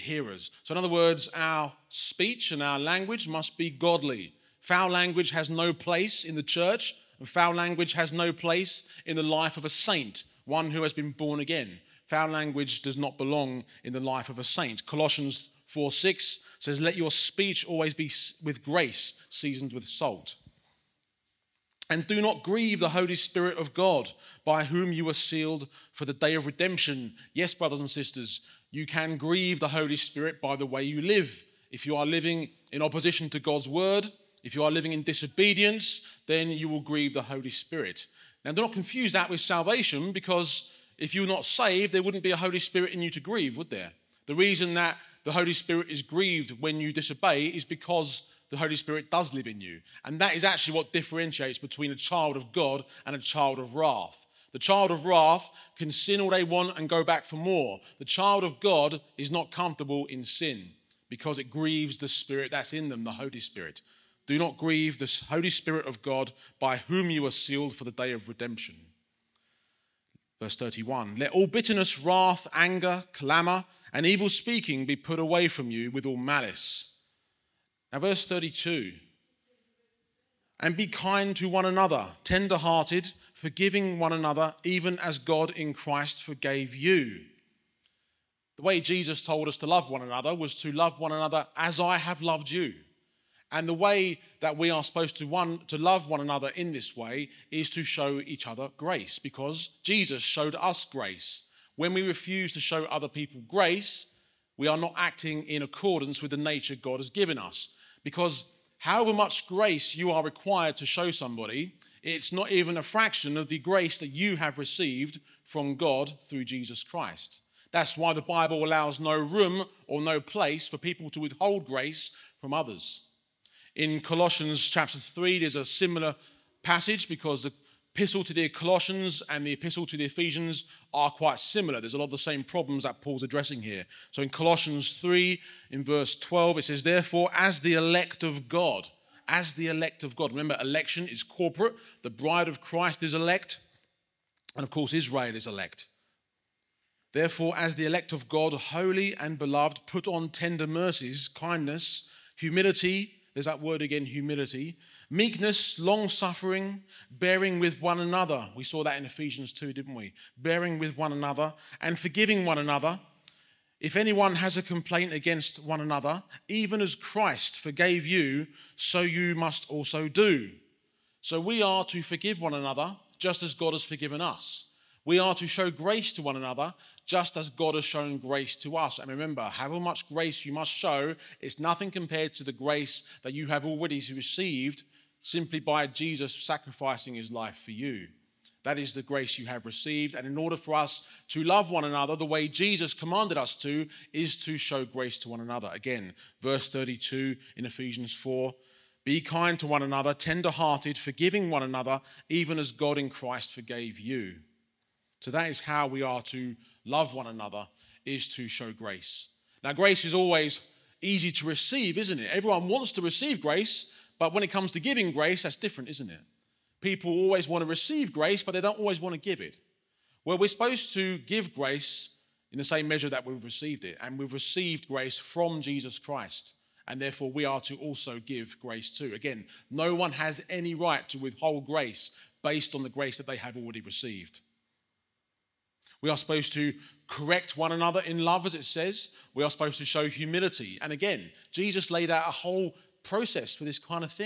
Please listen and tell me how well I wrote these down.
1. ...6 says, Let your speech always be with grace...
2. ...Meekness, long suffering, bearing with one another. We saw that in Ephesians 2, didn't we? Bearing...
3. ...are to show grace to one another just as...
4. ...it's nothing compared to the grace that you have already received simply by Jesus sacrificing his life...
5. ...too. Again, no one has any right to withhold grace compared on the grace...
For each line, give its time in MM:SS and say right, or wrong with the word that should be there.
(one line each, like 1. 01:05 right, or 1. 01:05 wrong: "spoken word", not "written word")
1. 00:15 right
2. 02:35 right
3. 02:55 right
4. 03:01 right
5. 03:48 wrong: "based", not "compared".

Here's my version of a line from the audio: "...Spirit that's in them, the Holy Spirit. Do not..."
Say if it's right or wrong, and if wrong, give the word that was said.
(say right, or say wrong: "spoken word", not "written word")
right.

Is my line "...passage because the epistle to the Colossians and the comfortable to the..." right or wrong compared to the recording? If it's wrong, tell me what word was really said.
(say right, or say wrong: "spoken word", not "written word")
wrong: "epistle", not "comfortable".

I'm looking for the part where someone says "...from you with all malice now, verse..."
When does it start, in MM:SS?
01:15.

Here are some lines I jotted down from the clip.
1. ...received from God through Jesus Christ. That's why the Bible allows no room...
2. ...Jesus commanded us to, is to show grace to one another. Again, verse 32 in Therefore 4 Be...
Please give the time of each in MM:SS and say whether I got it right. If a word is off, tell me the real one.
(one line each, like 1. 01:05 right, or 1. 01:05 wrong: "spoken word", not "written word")
1. 01:54 right
2. 03:12 wrong: "Ephesians", not "Therefore".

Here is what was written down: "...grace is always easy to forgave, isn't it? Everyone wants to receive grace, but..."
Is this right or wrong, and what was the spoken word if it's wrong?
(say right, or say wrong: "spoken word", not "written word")
wrong: "receive", not "forgave".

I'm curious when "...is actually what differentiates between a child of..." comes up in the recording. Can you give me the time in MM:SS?
00:50.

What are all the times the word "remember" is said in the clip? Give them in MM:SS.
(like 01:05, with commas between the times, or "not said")
02:20, 02:59.